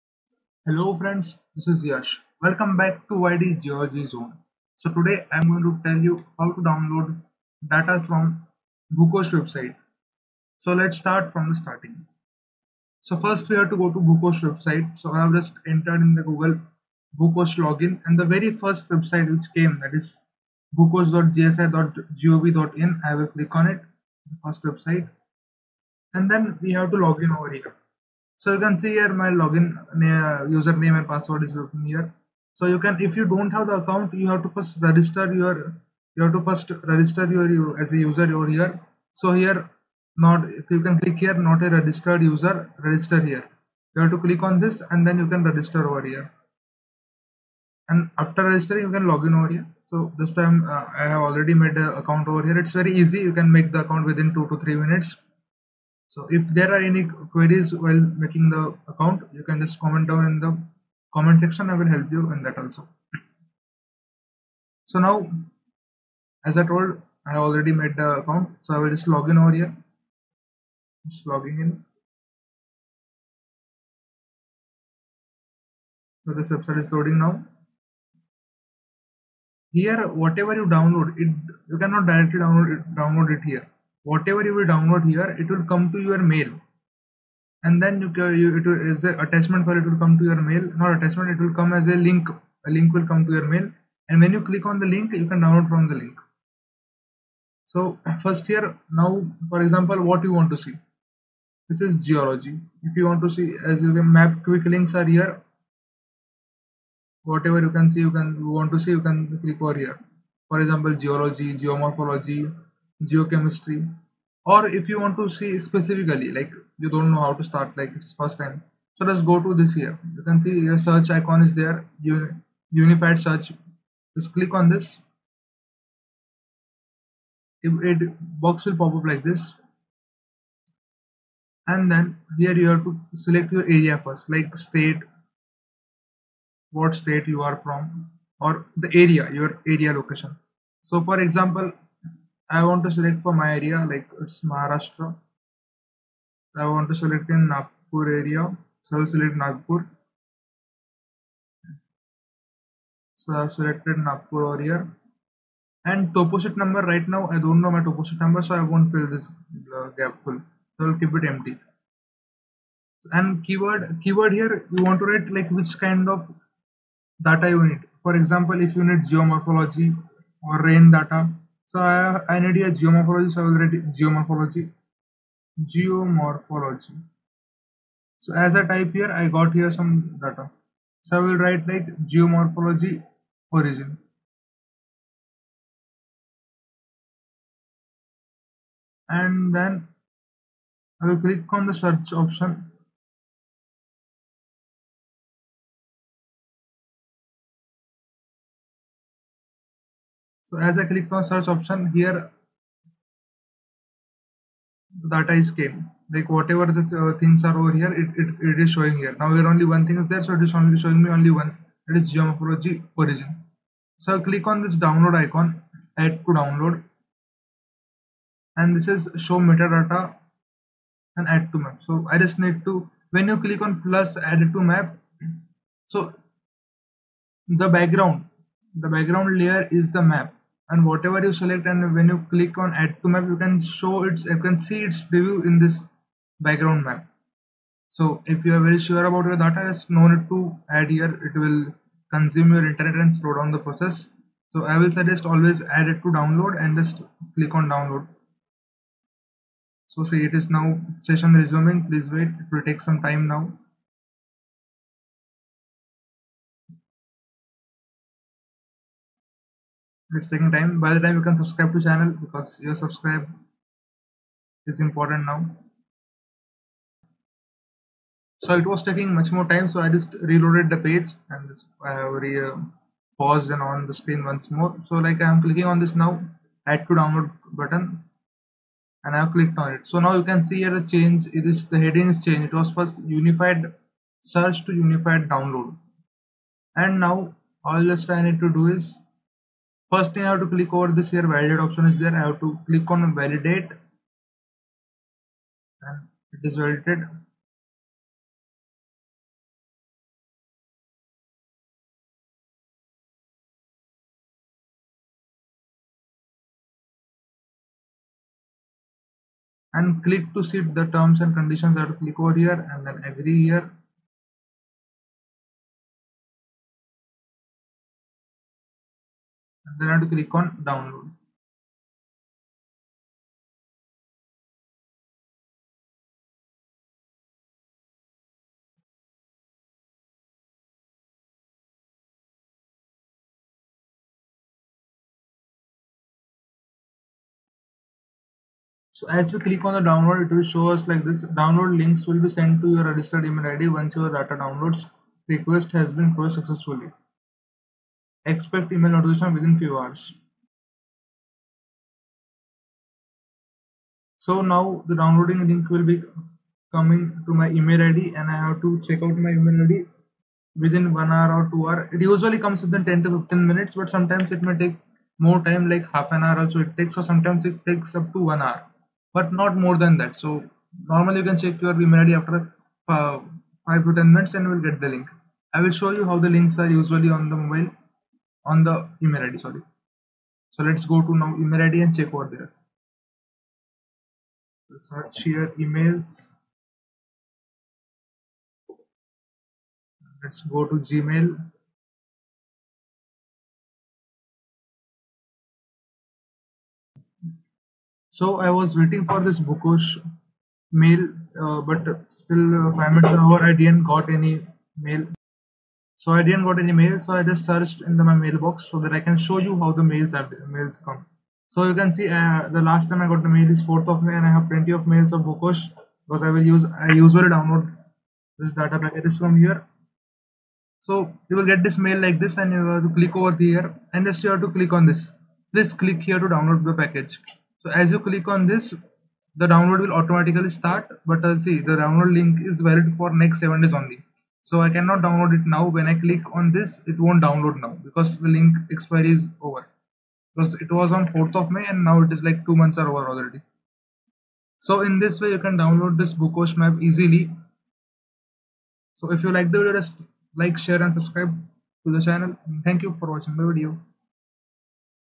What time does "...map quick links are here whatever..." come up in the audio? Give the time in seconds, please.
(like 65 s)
104 s.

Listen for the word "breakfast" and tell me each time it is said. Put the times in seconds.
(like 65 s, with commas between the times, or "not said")
not said.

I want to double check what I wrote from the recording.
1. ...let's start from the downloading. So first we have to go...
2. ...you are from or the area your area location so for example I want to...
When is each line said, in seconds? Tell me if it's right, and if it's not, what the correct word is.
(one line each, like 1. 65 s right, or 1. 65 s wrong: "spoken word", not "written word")
1. 10 s wrong: "starting", not "downloading"
2. 137 s right.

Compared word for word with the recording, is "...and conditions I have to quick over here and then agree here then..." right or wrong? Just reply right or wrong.
wrong.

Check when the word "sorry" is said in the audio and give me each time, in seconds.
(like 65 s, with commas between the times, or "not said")
379 s.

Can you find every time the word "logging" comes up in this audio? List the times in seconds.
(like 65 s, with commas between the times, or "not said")
71 s.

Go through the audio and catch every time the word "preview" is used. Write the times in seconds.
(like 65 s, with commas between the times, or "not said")
235 s.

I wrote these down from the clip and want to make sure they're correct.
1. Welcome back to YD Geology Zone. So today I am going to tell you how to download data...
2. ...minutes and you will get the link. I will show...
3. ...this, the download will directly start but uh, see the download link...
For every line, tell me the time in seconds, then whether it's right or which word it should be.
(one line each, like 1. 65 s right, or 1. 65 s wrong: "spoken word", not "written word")
1. 2 s right
2. 374 s right
3. 428 s wrong: "automatically", not "directly".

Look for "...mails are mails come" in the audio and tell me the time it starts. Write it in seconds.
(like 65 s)
409 s.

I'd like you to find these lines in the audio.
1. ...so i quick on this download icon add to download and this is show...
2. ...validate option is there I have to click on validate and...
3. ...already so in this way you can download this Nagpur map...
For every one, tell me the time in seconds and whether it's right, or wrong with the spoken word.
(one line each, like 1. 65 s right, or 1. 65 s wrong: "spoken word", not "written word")
1. 214 s wrong: "click", not "quick"
2. 291 s right
3. 443 s wrong: "Bhukosh", not "Nagpur".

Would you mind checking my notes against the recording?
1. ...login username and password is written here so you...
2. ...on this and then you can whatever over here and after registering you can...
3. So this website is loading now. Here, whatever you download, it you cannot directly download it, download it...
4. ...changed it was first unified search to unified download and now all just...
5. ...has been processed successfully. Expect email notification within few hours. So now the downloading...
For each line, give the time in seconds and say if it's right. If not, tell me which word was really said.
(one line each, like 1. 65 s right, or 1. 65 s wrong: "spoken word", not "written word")
1. 29 s right
2. 44 s wrong: "register", not "whatever"
3. 76 s right
4. 282 s right
5. 345 s right.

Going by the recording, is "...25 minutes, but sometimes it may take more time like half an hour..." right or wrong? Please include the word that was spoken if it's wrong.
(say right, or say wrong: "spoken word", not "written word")
wrong: "15", not "25".